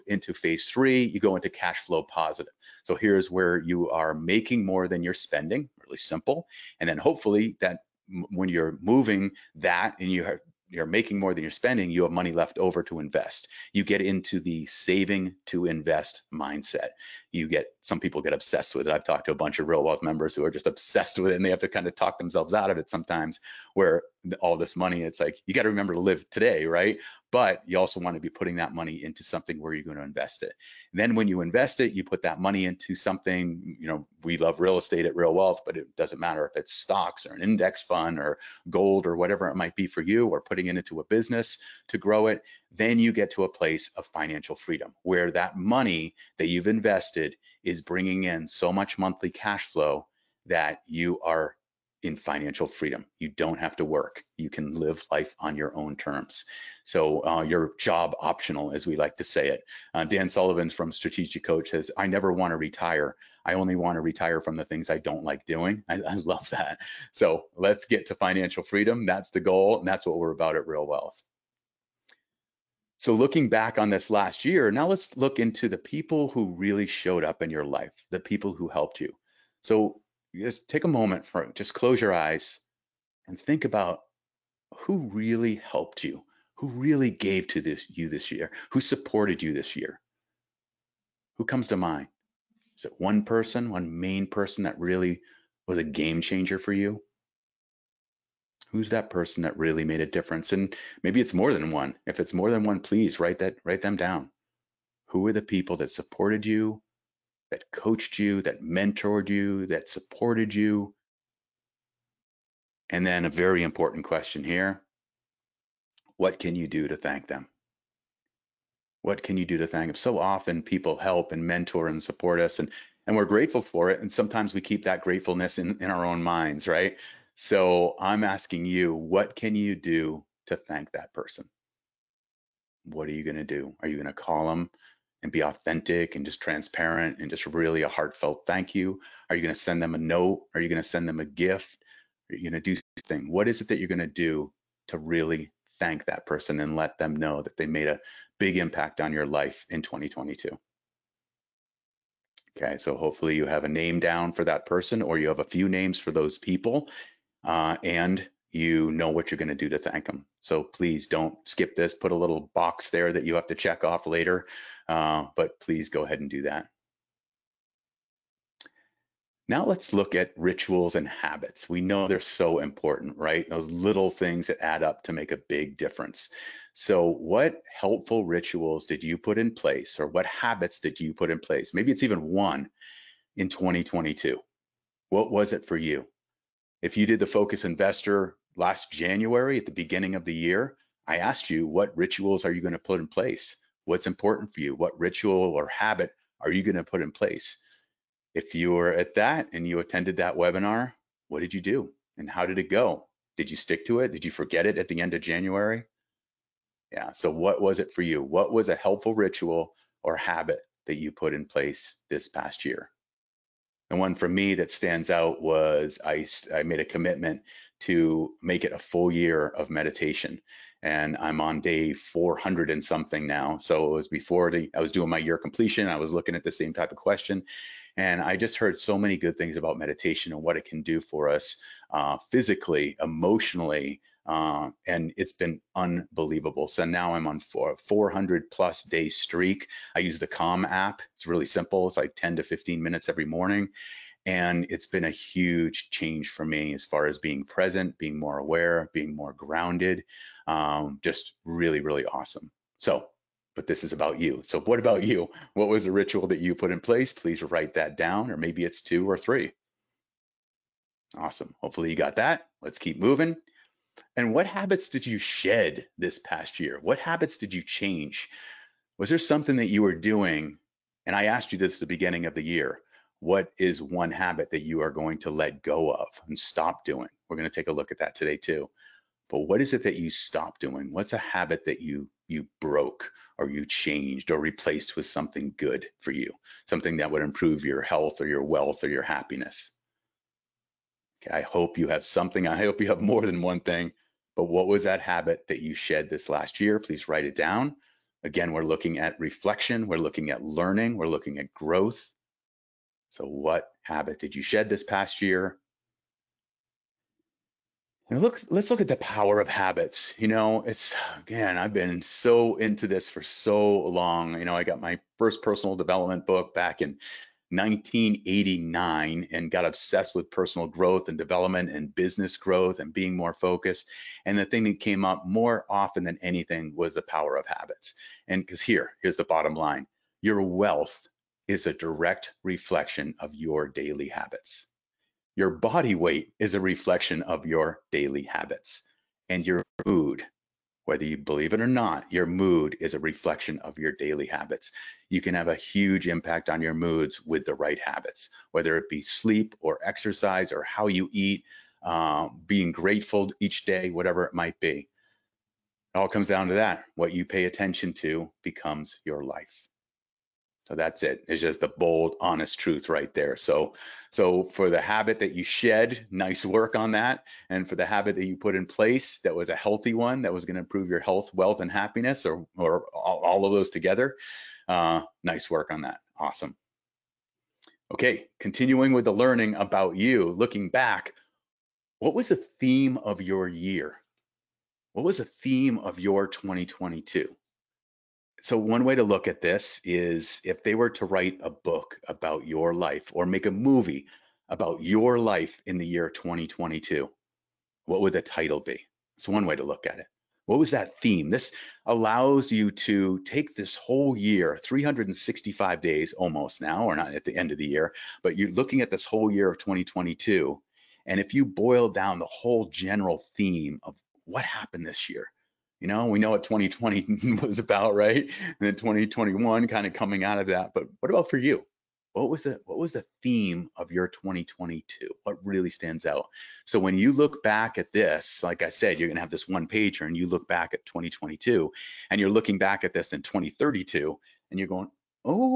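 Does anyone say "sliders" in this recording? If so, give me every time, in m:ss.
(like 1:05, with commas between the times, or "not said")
not said.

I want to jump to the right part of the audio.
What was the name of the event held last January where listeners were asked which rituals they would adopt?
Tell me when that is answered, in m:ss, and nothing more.
3:07.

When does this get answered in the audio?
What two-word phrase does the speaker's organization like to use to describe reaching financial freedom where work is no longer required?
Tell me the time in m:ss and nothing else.
0:57.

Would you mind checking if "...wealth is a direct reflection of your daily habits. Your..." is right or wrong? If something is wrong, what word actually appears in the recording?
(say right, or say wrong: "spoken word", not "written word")
right.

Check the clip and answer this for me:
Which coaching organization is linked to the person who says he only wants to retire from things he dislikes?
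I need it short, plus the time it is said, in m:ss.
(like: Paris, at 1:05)
Strategic Coach, at 1:00.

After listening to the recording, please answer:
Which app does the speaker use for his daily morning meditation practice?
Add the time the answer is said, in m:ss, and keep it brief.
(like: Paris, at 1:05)
Calm, at 4:00.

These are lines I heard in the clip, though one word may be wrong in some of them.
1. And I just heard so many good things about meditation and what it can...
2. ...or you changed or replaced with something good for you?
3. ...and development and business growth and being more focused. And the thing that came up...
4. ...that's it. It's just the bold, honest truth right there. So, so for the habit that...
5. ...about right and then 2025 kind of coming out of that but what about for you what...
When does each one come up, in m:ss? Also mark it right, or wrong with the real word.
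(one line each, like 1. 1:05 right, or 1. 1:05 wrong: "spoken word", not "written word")
1. 3:47 right
2. 4:43 right
3. 5:21 right
4. 6:00 right
5. 6:57 wrong: "2021", not "2025".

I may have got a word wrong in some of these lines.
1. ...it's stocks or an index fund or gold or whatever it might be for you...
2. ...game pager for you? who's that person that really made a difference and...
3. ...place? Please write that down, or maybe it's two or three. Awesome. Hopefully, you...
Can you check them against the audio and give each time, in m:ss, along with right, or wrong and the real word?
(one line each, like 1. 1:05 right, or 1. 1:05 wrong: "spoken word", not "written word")
1. 0:36 right
2. 1:36 wrong: "changer", not "pager"
3. 4:16 right.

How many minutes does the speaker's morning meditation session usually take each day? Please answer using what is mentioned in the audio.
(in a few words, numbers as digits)
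10 to 15.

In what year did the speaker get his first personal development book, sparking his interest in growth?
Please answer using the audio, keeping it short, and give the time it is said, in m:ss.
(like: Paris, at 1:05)
1989, at 5:17.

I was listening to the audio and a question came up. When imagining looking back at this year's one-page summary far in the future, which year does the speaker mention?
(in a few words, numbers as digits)
2032.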